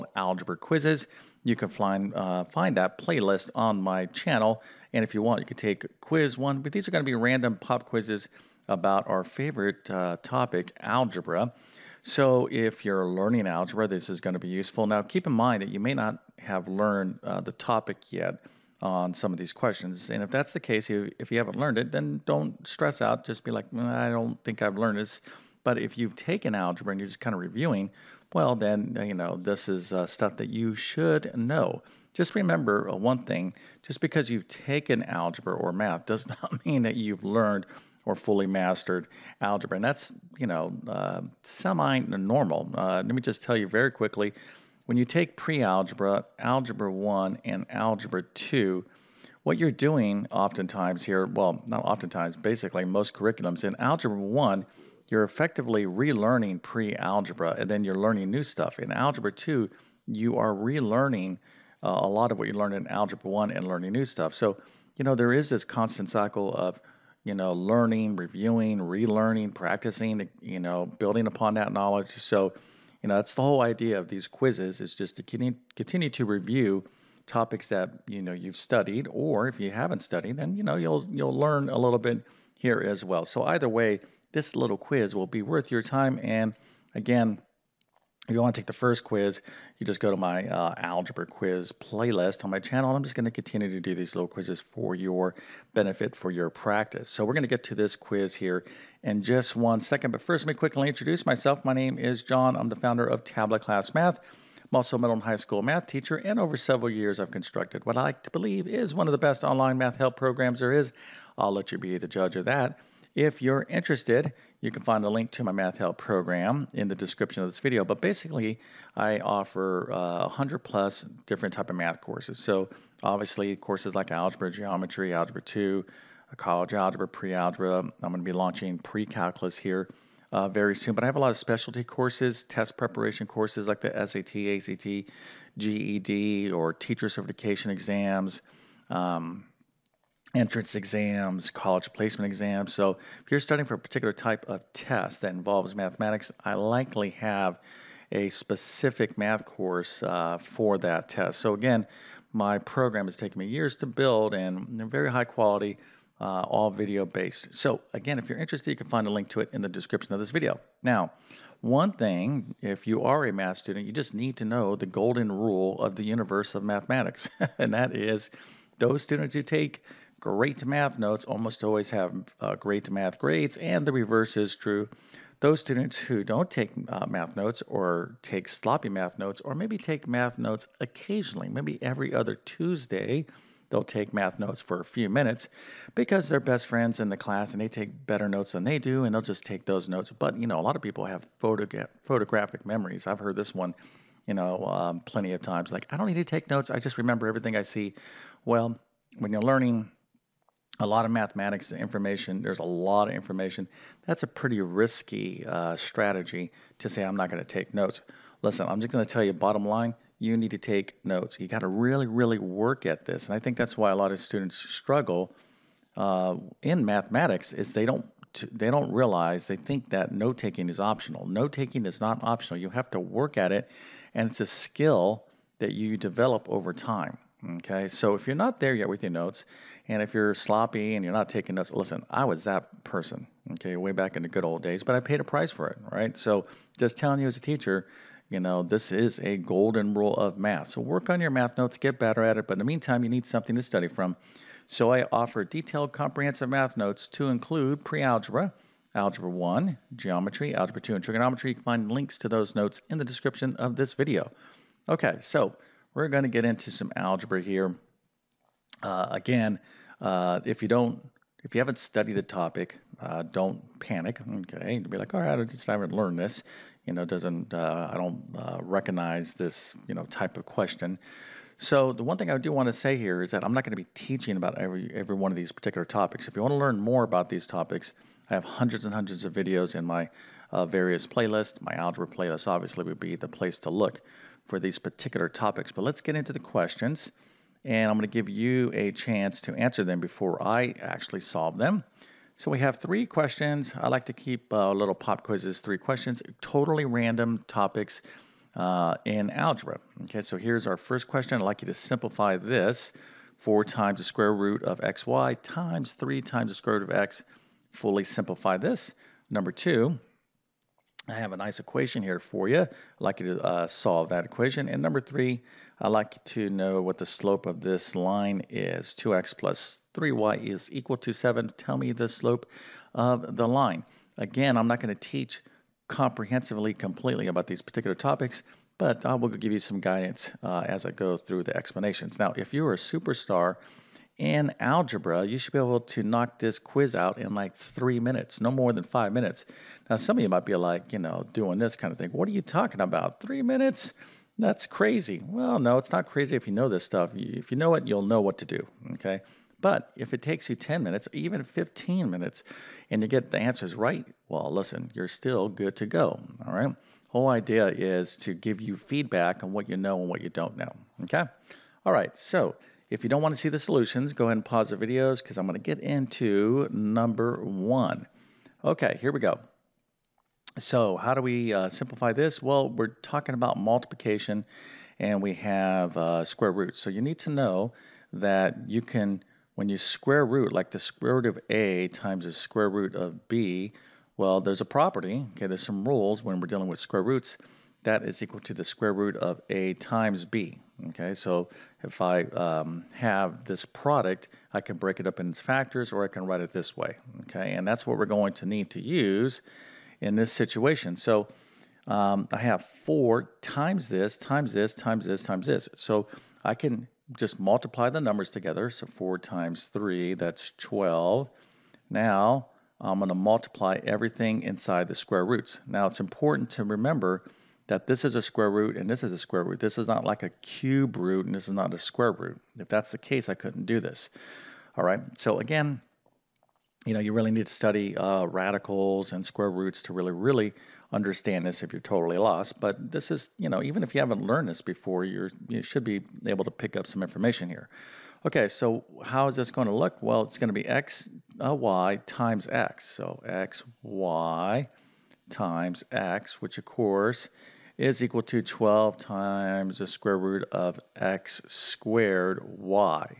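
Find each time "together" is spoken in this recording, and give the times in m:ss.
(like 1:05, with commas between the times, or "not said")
6:48.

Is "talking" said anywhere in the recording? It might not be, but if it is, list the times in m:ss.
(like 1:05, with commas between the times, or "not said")
5:42, 6:13.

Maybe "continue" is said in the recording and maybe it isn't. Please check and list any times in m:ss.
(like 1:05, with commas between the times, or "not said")
1:15, 1:33.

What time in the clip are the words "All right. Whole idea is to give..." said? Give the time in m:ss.
5:56.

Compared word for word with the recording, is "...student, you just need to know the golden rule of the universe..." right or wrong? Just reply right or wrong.
right.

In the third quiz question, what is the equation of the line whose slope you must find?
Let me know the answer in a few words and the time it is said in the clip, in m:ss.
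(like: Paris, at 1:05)
2x + 3y = 7, at 5:18.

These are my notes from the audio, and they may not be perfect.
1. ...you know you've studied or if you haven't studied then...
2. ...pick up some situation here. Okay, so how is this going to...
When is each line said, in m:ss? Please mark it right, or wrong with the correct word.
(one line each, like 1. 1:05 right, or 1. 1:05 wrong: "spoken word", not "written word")
1. 1:18 right
2. 7:16 wrong: "information", not "situation".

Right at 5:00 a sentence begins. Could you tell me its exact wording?
Okay, so here's our first question.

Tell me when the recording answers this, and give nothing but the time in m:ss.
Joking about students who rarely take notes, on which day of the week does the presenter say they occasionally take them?
3:01.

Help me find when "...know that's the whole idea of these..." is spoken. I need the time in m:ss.
1:13.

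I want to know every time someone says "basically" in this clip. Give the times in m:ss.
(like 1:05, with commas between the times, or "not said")
0:52, 1:58.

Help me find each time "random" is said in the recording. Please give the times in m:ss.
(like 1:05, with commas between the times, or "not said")
0:07, 4:56.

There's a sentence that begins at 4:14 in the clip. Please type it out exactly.
Okay, so we're going to get into some algebra here.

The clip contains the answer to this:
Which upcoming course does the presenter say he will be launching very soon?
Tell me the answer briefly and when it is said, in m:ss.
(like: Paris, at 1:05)
Pre-calculus, at 2:08.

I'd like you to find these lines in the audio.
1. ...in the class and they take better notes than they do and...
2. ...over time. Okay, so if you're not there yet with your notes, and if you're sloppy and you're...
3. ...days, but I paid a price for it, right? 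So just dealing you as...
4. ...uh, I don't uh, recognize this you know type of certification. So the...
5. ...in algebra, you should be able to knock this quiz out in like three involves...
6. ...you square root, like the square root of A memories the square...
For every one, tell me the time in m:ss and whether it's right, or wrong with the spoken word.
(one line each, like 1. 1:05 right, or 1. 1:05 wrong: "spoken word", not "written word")
1. 3:07 right
2. 3:46 right
3. 3:54 wrong: "telling", not "dealing"
4. 4:27 wrong: "question", not "certification"
5. 5:34 wrong: "minutes", not "involves"
6. 6:19 wrong: "times", not "memories".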